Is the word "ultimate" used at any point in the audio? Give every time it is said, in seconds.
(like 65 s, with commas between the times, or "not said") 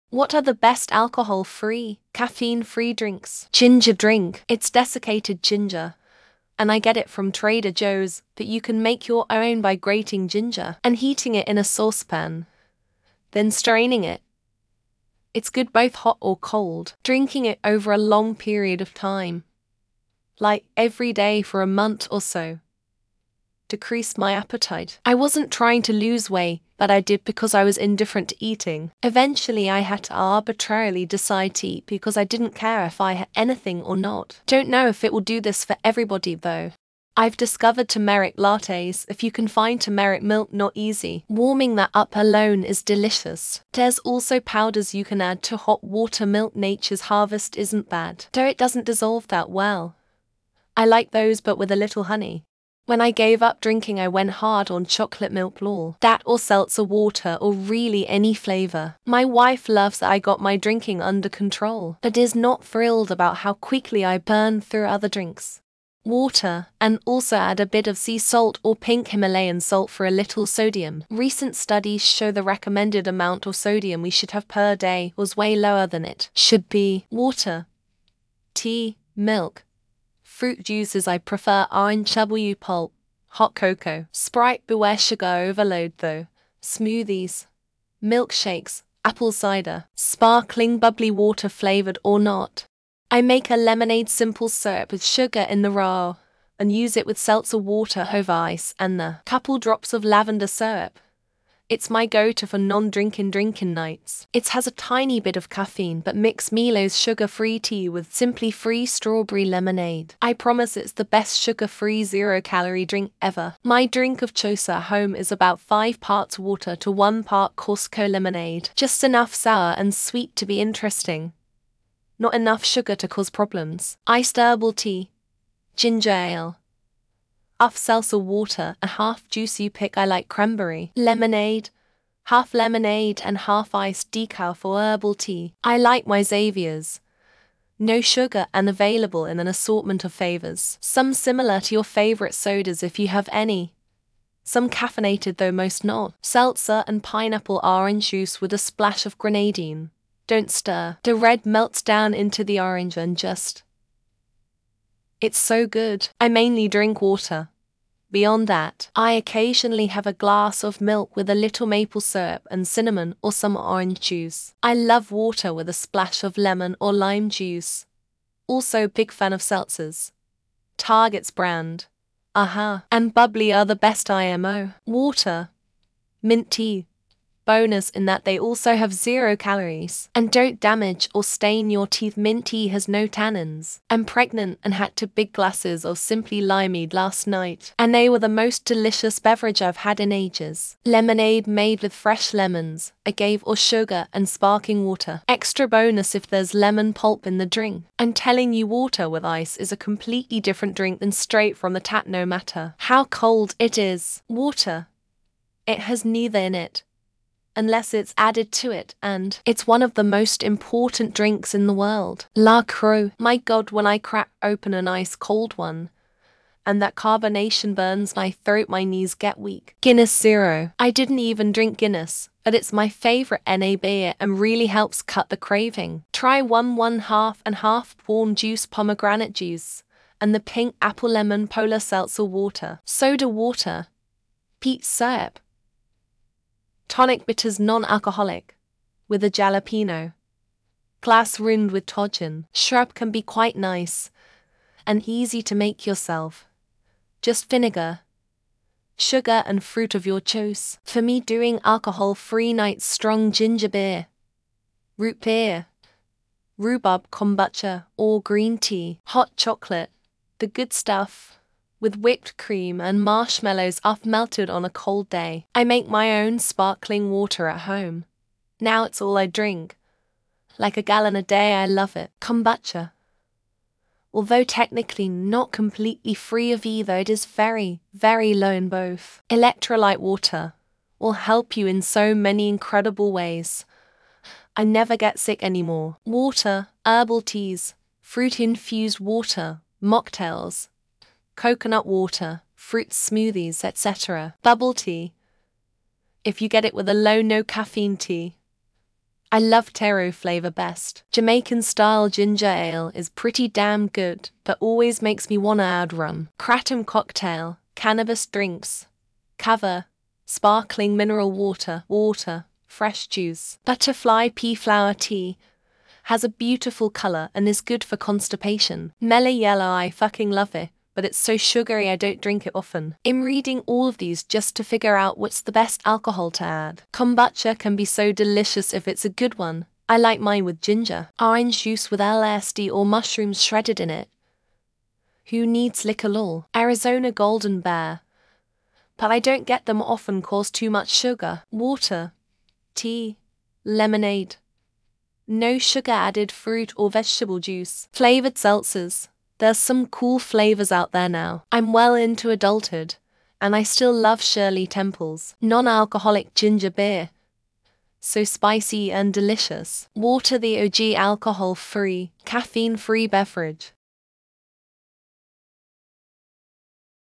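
not said.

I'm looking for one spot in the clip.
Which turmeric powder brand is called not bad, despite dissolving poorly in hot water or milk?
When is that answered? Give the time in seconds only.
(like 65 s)
46 s.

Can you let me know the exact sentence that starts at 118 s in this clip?
Just enough sour and sweet to be interesting.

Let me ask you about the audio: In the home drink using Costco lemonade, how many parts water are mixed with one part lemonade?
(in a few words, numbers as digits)
5.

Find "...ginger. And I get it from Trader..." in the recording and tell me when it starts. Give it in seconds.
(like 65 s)
5 s.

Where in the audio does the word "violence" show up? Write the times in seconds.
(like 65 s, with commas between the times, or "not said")
not said.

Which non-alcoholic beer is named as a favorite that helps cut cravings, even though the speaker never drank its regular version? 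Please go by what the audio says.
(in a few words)
Guinness Zero.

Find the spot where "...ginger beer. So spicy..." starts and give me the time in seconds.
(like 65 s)
356 s.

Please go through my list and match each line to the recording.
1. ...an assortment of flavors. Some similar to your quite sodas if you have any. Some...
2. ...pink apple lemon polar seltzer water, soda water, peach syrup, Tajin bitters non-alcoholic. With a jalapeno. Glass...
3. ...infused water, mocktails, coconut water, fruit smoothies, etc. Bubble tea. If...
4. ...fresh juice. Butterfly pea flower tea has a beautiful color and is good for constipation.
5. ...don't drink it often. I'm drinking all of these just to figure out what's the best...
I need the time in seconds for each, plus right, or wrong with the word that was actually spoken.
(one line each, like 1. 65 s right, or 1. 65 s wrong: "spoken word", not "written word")
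1. 139 s wrong: "favorite", not "quite"
2. 230 s wrong: "Tonic", not "Tajin"
3. 288 s right
4. 312 s right
5. 321 s wrong: "reading", not "drinking".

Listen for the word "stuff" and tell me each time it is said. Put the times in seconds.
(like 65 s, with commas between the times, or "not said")
260 s.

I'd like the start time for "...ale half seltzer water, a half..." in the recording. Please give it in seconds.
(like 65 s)
126 s.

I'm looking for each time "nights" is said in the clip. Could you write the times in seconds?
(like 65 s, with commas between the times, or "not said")
103 s, 187 s, 252 s.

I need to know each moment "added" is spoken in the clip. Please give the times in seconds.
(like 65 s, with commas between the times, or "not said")
208 s, 345 s.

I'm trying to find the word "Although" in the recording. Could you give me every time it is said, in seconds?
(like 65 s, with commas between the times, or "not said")
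274 s.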